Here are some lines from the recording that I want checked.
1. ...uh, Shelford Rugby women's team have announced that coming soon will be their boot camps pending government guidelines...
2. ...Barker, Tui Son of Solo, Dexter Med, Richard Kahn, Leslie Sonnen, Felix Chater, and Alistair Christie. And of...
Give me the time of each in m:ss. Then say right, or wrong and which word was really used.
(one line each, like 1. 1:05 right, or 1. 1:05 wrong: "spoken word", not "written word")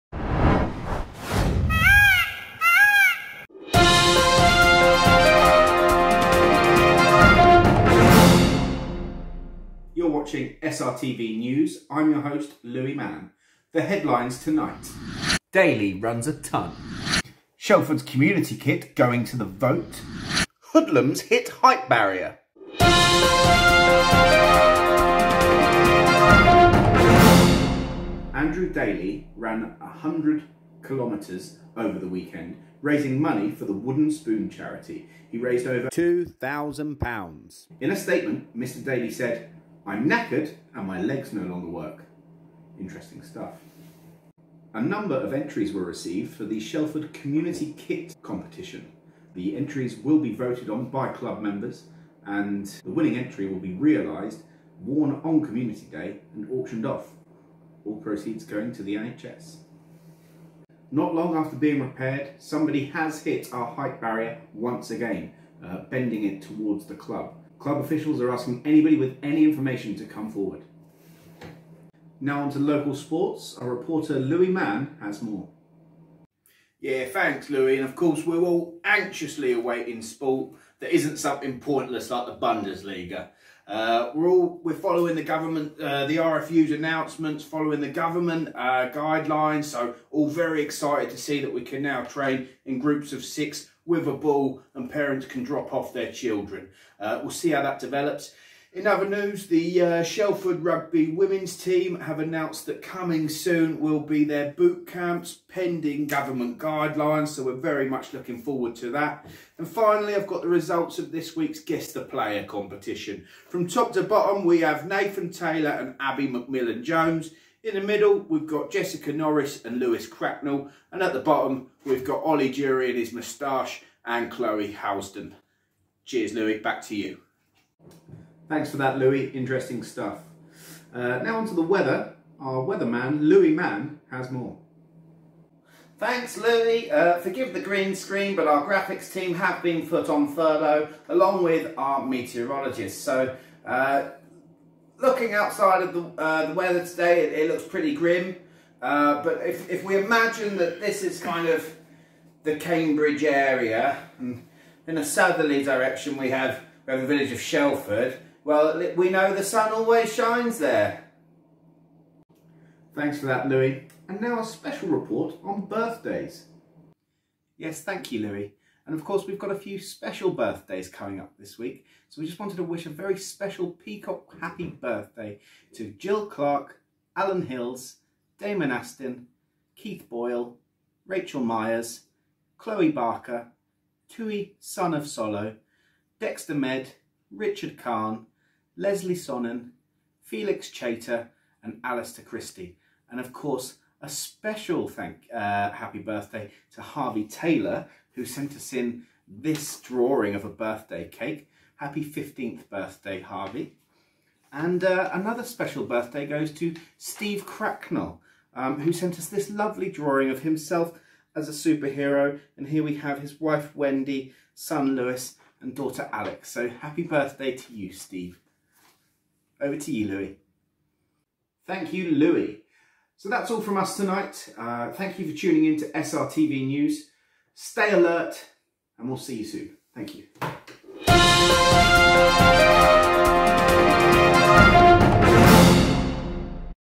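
1. 1:39 right
2. 3:02 right.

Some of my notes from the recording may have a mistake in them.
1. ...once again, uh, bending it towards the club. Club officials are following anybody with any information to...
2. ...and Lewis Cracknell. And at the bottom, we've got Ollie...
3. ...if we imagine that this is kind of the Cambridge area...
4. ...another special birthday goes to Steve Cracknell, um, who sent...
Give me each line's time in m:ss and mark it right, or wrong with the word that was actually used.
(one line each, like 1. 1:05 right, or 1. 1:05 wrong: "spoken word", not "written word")
1. 1:04 wrong: "asking", not "following"
2. 1:59 right
3. 2:29 right
4. 3:25 right.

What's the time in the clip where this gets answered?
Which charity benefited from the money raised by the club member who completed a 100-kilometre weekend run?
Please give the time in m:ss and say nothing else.
0:33.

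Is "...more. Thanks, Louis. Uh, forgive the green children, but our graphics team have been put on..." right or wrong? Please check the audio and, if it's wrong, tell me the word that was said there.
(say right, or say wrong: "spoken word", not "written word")
wrong: "screen", not "children".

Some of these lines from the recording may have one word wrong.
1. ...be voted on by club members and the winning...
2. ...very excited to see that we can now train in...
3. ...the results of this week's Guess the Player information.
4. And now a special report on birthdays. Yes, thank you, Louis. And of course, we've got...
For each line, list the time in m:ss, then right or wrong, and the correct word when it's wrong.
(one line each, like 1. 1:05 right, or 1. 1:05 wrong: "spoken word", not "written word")
1. 0:50 right
2. 1:30 right
3. 1:50 wrong: "competition", not "information"
4. 2:44 right.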